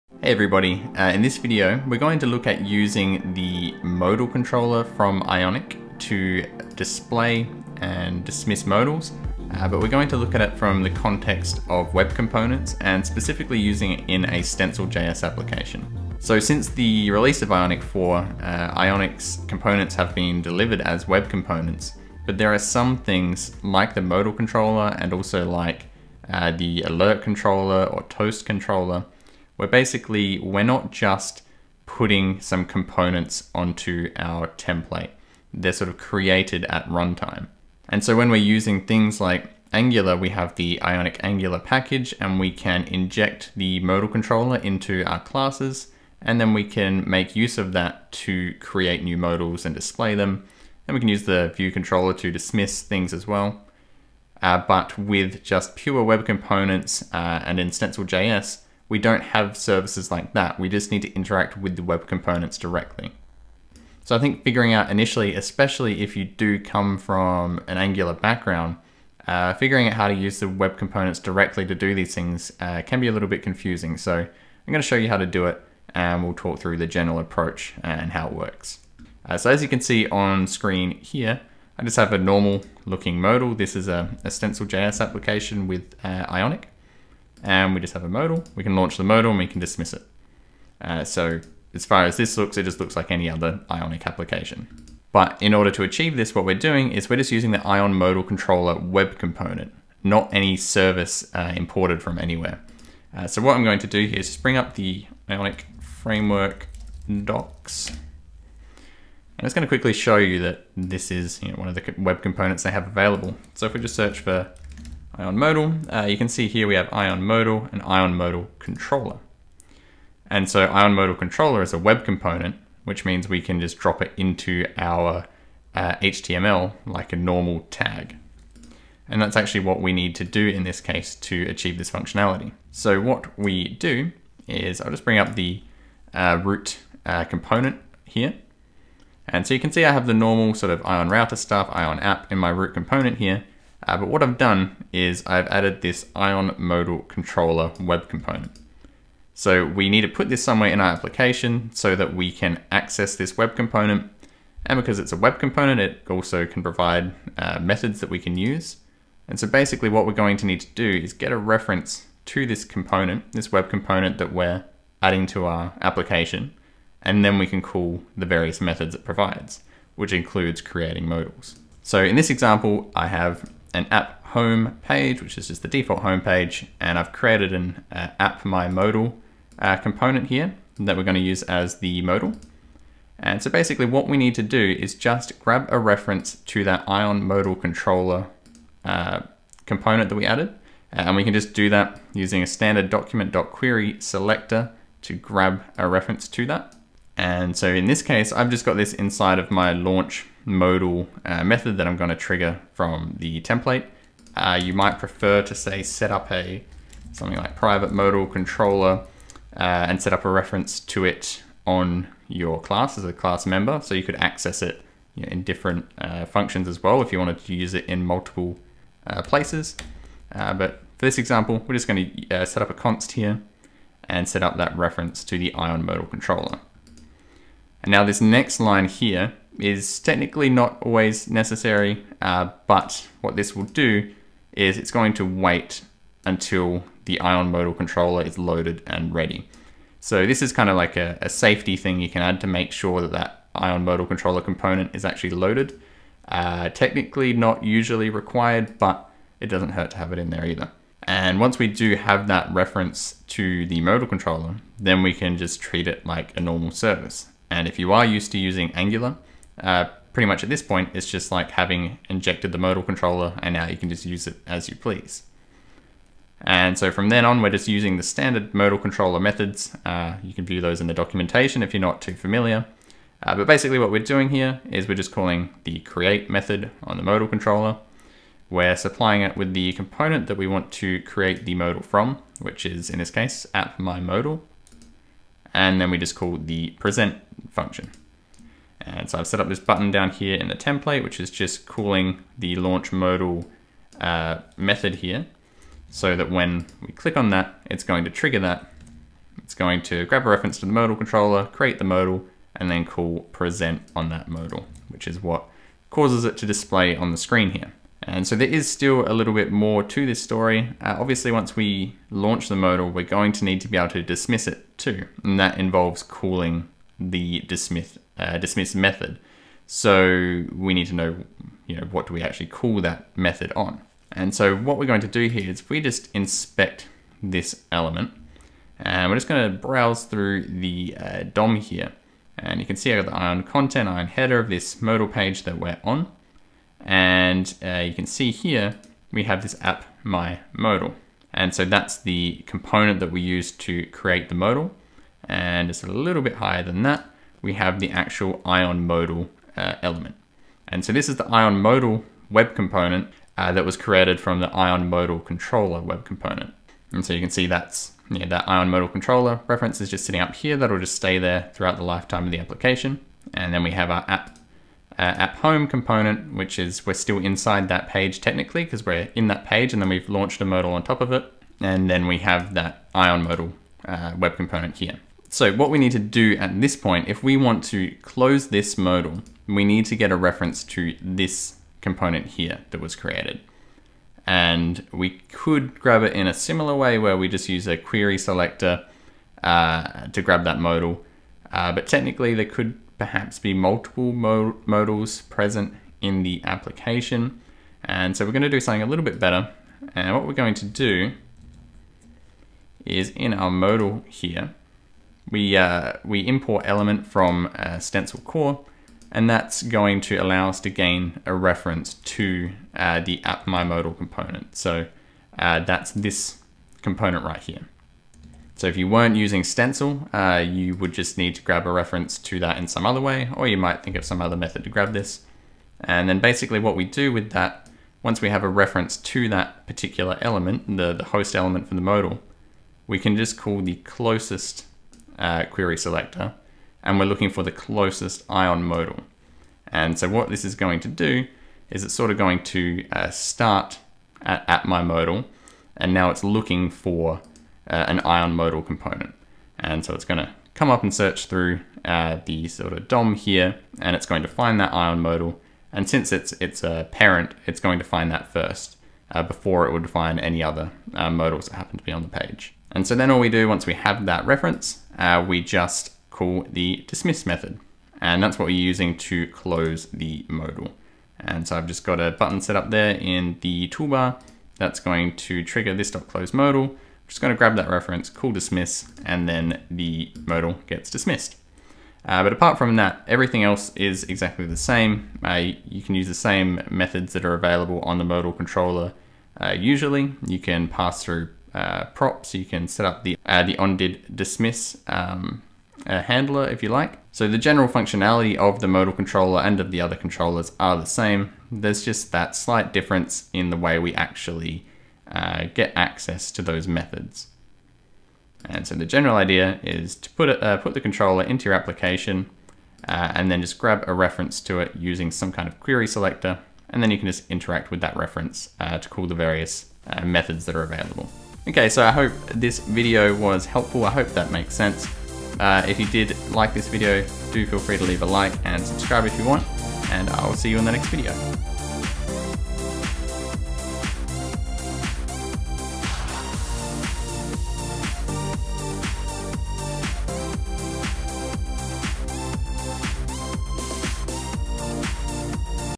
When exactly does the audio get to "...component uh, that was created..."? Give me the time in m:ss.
5:52.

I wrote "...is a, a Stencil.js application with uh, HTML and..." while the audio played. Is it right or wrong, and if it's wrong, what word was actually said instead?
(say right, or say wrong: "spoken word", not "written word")
wrong: "Ionic", not "HTML".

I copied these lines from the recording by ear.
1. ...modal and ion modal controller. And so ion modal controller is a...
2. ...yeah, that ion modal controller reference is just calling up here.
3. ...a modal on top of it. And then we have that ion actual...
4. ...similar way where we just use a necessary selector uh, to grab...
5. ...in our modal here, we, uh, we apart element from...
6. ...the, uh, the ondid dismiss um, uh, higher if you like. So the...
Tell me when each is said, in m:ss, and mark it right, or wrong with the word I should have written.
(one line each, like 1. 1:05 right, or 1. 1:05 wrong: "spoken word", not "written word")
1. 1:57 right
2. 5:58 wrong: "sitting", not "calling"
3. 6:10 wrong: "modal", not "actual"
4. 6:26 wrong: "query", not "necessary"
5. 6:43 wrong: "import", not "apart"
6. 8:13 wrong: "handler", not "higher".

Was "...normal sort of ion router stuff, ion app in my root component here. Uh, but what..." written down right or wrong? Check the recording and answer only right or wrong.
right.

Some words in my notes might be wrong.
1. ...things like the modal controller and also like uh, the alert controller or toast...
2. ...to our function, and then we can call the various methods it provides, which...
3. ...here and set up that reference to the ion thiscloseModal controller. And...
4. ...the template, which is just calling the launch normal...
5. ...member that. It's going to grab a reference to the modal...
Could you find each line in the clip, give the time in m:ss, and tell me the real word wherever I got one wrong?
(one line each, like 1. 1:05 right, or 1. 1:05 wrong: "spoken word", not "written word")
1. 0:22 right
2. 2:45 wrong: "application", not "function"
3. 3:43 wrong: "modal", not "thiscloseModal"
4. 4:50 wrong: "modal", not "normal"
5. 4:58 wrong: "trigger", not "member".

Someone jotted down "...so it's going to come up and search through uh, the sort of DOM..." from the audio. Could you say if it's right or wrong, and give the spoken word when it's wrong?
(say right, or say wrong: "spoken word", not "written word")
right.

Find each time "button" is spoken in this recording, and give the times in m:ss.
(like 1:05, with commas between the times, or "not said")
4:49, 7:52.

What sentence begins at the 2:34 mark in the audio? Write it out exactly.
And because it's a web component, it also can provide uh, methods that we can use.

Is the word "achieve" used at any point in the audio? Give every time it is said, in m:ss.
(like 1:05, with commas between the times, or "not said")
1:35, 2:11.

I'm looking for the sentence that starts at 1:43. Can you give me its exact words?
Uh, so what I'm going to do here is just bring up the Ionic framework docs.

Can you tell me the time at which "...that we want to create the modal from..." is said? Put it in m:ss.
4:40.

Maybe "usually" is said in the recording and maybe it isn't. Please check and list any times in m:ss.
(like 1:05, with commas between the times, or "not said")
4:07, 8:09.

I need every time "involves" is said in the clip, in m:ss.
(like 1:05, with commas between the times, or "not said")
5:15.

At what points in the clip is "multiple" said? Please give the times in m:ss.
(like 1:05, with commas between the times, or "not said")
3:38, 6:33.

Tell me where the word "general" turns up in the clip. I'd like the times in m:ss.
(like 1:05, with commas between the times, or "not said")
1:16, 8:17, 8:28.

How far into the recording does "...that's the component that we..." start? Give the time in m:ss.
5:41.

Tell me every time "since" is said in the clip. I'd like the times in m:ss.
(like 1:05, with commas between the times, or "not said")
0:16, 7:35.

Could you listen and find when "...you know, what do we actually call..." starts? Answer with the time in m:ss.
5:21.